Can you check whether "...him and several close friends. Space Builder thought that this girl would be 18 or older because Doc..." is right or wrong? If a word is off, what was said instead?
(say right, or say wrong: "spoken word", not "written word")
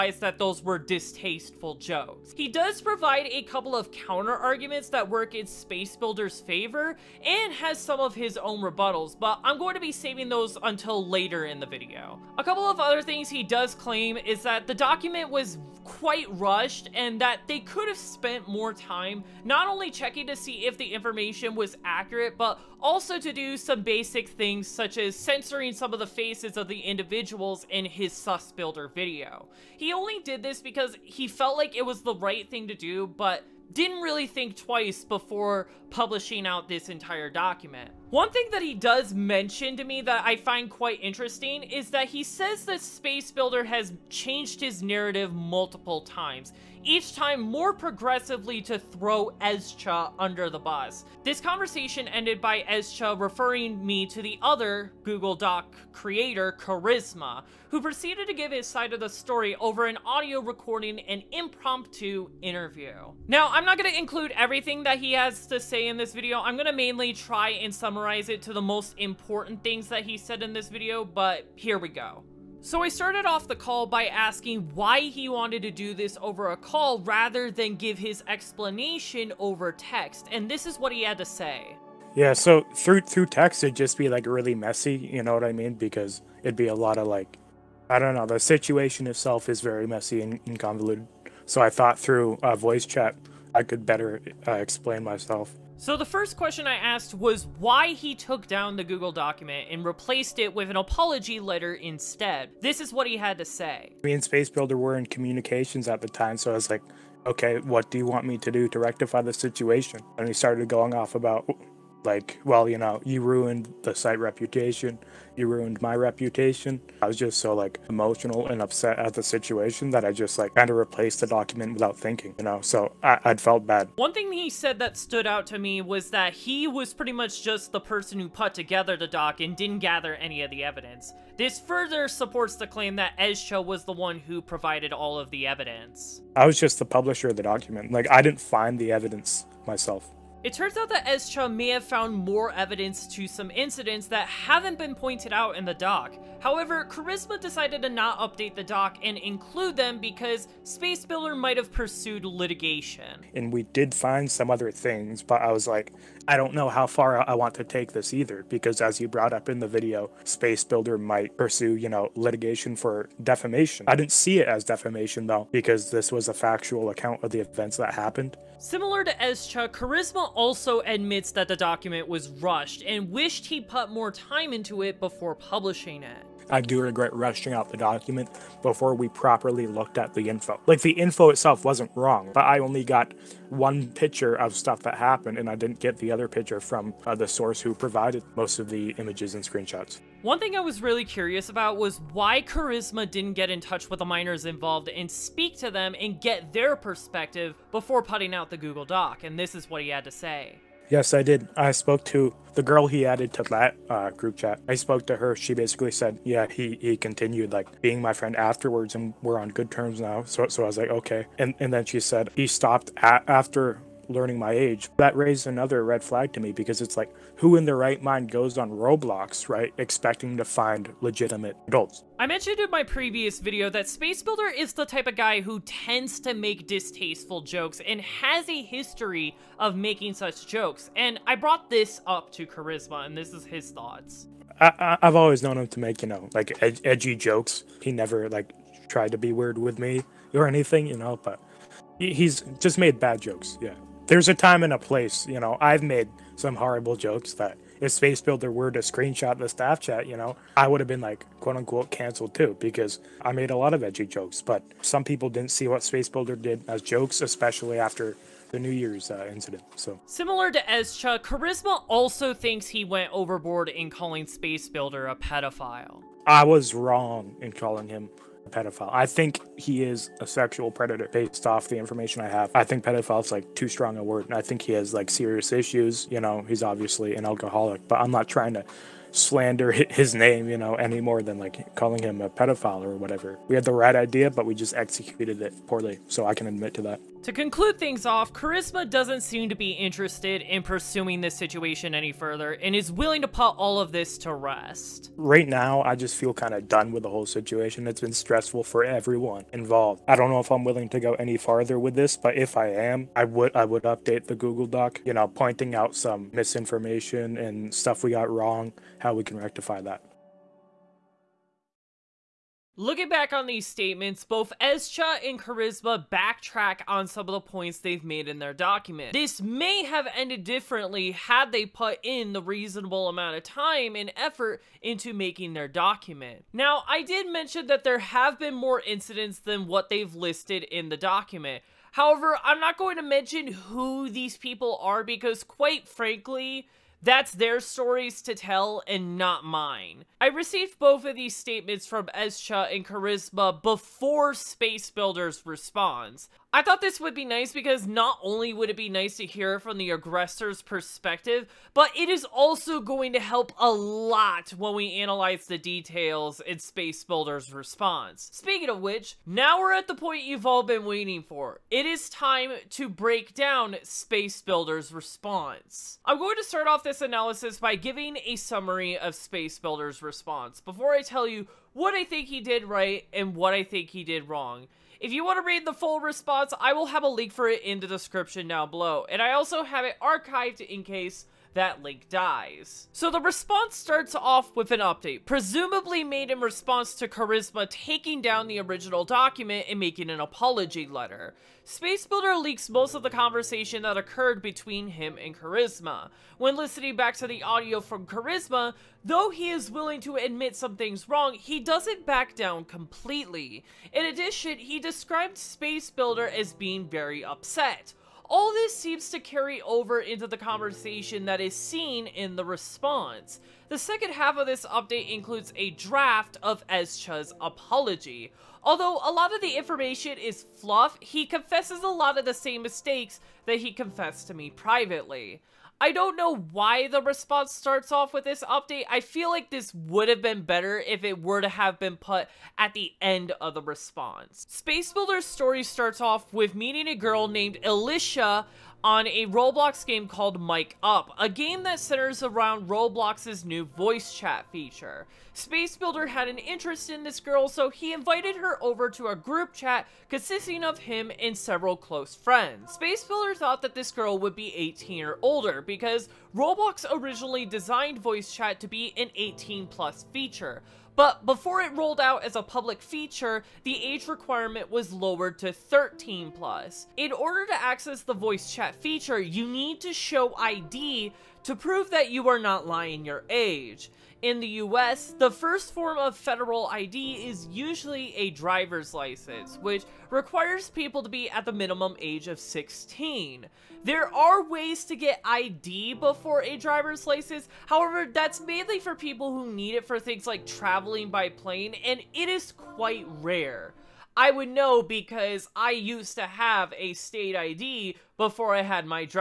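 wrong: "Roblox", not "Doc".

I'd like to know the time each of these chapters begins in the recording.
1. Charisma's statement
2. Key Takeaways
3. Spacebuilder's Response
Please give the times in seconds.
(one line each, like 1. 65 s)
1. 50 s
2. 312 s
3. 357 s.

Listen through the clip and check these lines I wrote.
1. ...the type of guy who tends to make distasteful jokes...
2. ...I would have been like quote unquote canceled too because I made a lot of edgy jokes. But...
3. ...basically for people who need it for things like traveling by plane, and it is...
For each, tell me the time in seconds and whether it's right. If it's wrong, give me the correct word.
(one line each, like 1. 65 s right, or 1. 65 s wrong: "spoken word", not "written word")
1. 224 s right
2. 250 s right
3. 488 s wrong: "mainly", not "basically".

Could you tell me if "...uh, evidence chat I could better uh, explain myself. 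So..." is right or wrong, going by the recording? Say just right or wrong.
wrong.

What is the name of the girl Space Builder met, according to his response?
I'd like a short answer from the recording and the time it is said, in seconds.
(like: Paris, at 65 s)
Elisha, at 437 s.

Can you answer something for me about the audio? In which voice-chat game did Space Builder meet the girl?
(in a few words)
Mic Up.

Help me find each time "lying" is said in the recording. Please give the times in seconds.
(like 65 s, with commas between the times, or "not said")
472 s.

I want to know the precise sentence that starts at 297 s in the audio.
It's been stressful for everyone involved.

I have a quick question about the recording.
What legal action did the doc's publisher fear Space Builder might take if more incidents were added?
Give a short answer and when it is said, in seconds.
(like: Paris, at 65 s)
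litigation for defamation, at 162 s.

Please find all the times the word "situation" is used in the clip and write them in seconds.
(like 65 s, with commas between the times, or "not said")
88 s, 109 s, 119 s, 291 s, 297 s.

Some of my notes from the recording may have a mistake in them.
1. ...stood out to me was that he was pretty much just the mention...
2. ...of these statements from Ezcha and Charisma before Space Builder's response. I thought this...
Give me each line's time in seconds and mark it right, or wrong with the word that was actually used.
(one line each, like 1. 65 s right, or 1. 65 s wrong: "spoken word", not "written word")
1. 124 s wrong: "person", not "mention"
2. 341 s right.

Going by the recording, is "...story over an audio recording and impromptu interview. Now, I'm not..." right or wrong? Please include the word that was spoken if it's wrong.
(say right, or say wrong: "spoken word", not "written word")
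right.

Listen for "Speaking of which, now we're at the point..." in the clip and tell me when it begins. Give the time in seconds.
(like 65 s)
358 s.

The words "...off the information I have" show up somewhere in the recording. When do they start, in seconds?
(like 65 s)
271 s.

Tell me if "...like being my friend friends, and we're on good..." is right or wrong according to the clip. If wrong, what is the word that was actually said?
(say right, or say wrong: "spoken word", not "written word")
wrong: "afterwards", not "friends".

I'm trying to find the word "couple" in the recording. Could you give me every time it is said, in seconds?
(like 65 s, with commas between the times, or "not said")
3 s, 12 s.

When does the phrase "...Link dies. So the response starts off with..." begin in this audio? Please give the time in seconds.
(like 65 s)
381 s.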